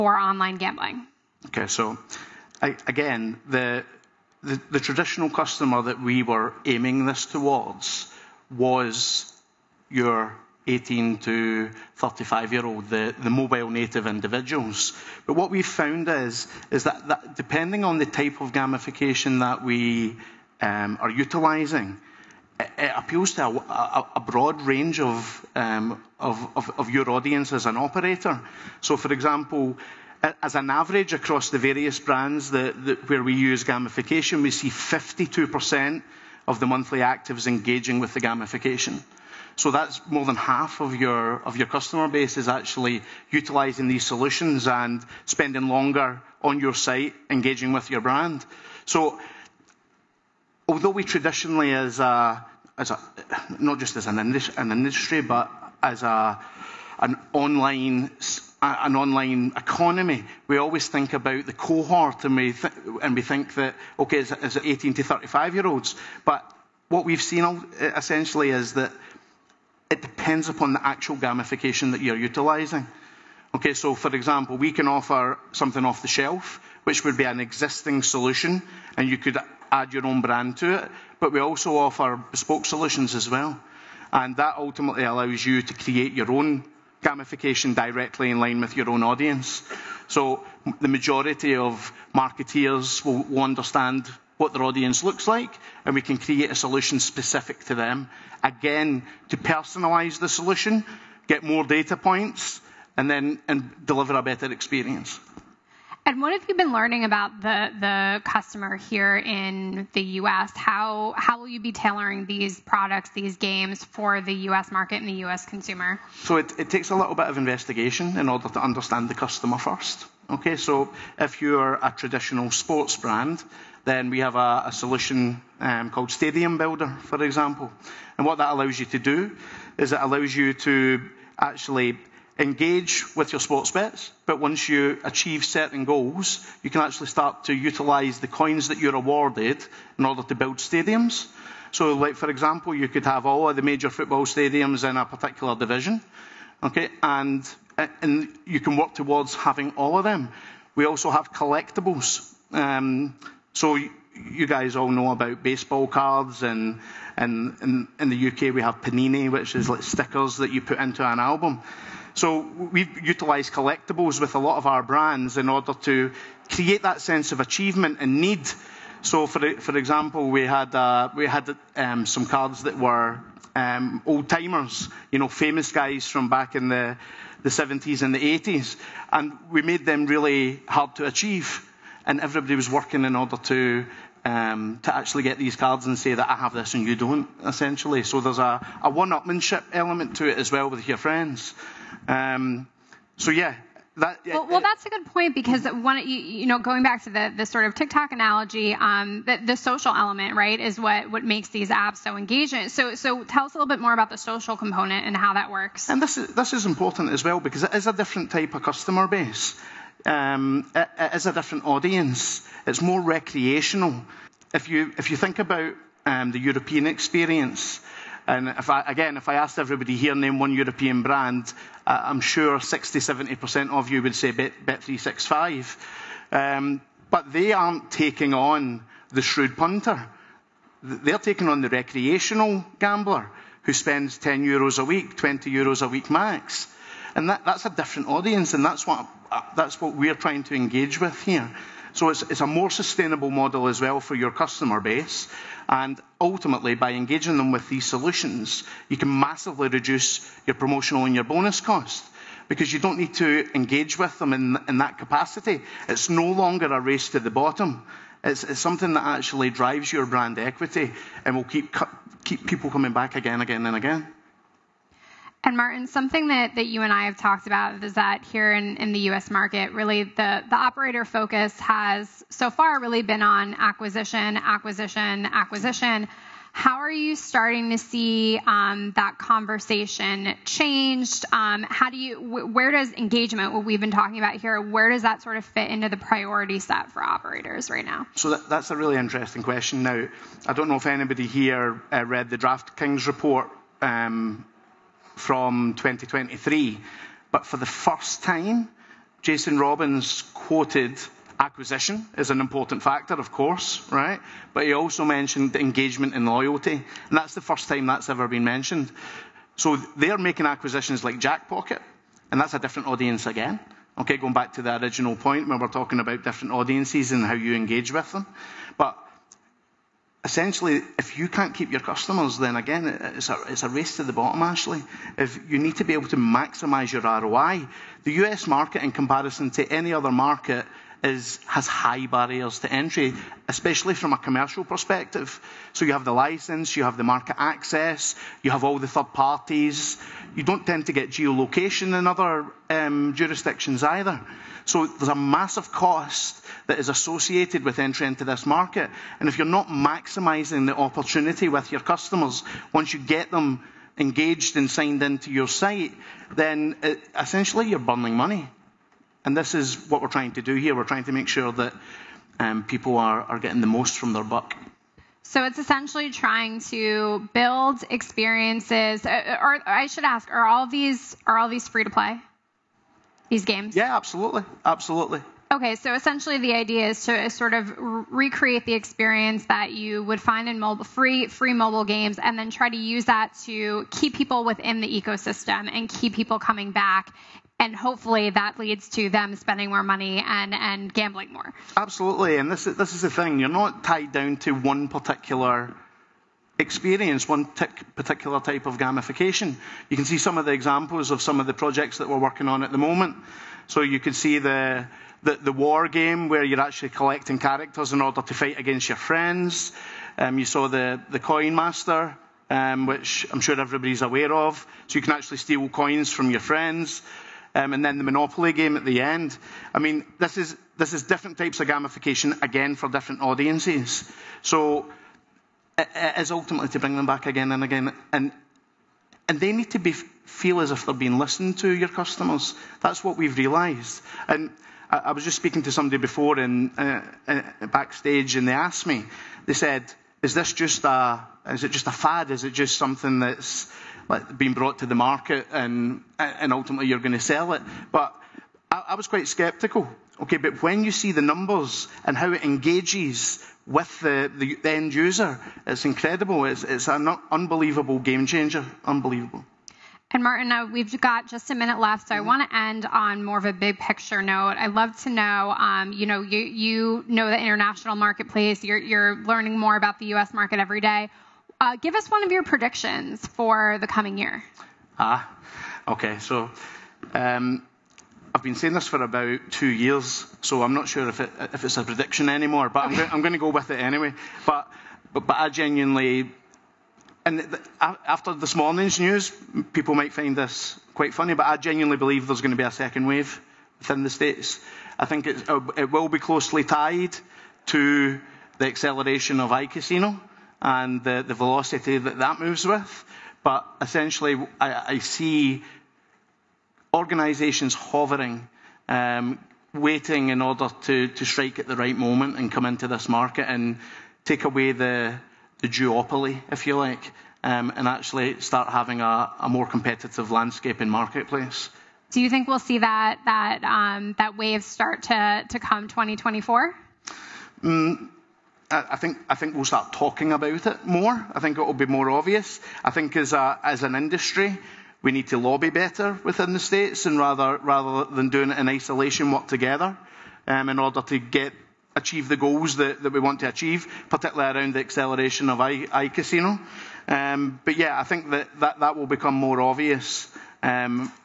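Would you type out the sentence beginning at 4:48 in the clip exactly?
So that, that's a really interesting question.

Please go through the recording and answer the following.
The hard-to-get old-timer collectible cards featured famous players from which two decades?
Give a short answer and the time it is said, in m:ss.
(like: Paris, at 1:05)
70s and 80s, at 2:57.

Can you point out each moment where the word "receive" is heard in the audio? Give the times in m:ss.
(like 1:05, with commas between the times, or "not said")
not said.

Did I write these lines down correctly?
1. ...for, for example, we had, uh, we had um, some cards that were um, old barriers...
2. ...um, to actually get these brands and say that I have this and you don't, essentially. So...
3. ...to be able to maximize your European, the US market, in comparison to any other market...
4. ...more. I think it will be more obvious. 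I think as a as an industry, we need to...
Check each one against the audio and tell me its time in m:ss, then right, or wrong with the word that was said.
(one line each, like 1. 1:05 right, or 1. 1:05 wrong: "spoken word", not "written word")
1. 2:49 wrong: "timers", not "barriers"
2. 3:04 wrong: "cards", not "brands"
3. 5:25 wrong: "ROI", not "European"
4. 8:50 right.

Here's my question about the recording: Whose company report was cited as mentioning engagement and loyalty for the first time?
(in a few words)
Jason Robins.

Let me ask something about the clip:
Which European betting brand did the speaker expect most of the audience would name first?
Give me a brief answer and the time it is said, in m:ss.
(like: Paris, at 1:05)
Bet365, at 3:44.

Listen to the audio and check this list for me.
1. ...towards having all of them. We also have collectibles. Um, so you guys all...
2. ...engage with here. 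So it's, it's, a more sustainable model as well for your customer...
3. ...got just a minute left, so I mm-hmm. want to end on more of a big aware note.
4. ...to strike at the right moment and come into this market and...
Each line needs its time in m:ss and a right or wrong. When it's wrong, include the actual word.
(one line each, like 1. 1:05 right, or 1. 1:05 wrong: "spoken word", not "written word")
1. 2:28 right
2. 4:00 right
3. 7:41 wrong: "picture", not "aware"
4. 8:31 right.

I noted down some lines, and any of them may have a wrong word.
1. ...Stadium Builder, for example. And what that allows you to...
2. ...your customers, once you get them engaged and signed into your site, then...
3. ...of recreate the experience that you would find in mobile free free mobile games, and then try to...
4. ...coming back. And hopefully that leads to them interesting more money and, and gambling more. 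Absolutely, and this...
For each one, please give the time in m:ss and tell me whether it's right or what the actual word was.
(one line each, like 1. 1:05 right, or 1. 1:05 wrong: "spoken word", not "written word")
1. 2:06 right
2. 5:51 right
3. 6:17 right
4. 6:26 wrong: "spending", not "interesting".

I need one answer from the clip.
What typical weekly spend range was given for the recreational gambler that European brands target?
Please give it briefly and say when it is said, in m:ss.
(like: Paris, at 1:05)
10 to 20 euros, at 3:54.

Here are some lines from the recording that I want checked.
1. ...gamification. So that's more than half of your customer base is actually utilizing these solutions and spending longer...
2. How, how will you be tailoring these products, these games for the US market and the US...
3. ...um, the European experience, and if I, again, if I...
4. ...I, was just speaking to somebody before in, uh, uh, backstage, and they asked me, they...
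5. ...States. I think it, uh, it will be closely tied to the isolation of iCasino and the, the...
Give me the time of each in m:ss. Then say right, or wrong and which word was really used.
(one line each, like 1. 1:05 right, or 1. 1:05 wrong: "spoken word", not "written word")
1. 0:38 right
2. 1:50 right
3. 3:36 right
4. 7:14 right
5. 8:14 wrong: "acceleration", not "isolation".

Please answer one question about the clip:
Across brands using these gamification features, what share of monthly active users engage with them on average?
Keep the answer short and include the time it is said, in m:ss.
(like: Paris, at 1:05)
52%, at 0:34.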